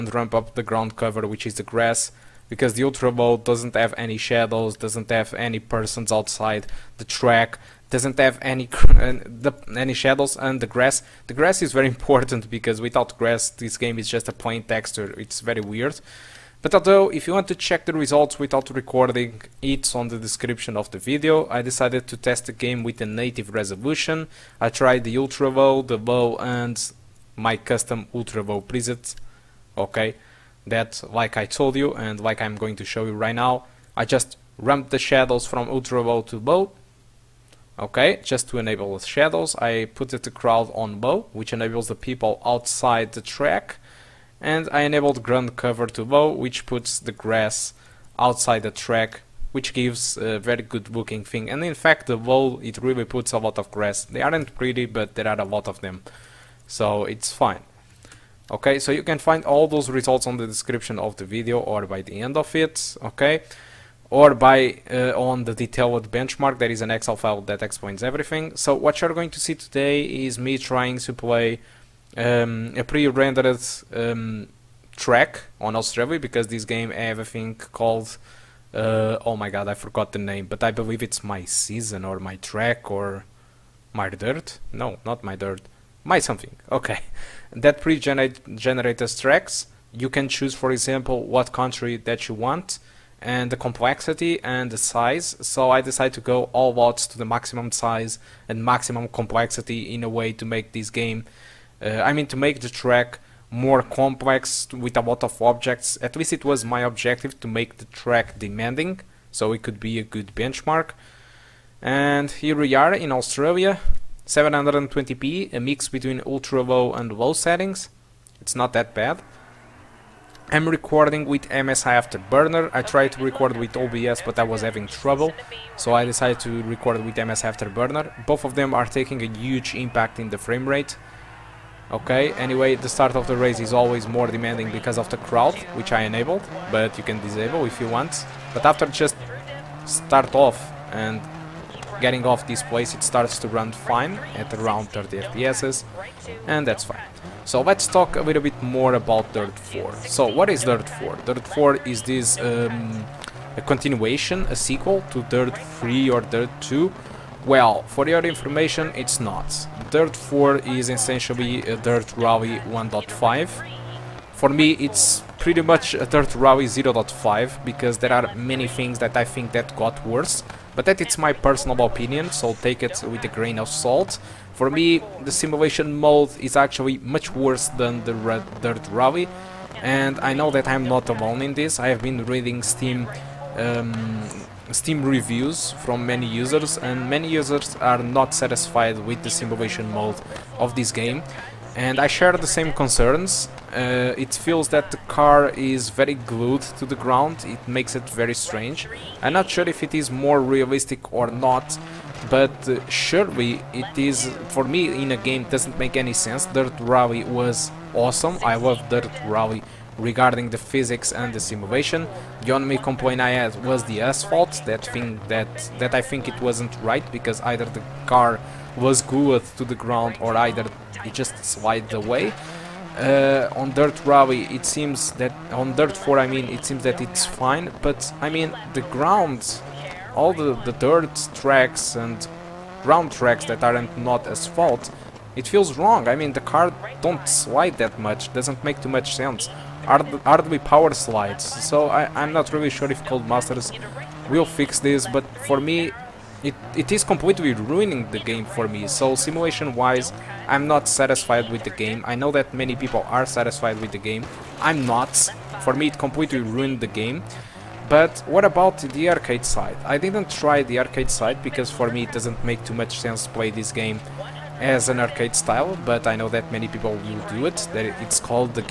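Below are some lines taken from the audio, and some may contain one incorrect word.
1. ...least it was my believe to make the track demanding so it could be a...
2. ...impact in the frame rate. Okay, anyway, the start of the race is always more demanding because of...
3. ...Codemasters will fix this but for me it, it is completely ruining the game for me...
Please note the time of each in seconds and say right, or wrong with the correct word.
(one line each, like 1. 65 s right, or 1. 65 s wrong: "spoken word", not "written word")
1. 106 s wrong: "objective", not "believe"
2. 129 s right
3. 243 s right.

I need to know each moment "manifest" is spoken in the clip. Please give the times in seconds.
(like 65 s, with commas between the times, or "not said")
not said.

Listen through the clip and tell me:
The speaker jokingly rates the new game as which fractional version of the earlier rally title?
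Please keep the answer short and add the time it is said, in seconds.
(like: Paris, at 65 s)
Dirt Rally 0.5, at 166 s.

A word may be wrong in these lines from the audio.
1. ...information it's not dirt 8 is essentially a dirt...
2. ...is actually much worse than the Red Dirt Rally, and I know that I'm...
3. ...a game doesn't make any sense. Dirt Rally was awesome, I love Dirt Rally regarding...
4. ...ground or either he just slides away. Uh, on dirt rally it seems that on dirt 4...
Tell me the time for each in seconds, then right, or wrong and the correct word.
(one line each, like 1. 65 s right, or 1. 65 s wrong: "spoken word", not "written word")
1. 158 s wrong: "4", not "8"
2. 176 s right
3. 205 s right
4. 219 s right.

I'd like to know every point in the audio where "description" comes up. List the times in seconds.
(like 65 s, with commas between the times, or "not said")
20 s, 60 s.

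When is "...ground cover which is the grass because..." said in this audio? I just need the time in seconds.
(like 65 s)
0 s.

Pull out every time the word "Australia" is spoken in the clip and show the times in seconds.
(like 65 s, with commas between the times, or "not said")
75 s, 113 s.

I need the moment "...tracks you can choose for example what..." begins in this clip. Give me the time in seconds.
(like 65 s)
89 s.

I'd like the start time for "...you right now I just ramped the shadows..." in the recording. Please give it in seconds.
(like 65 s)
33 s.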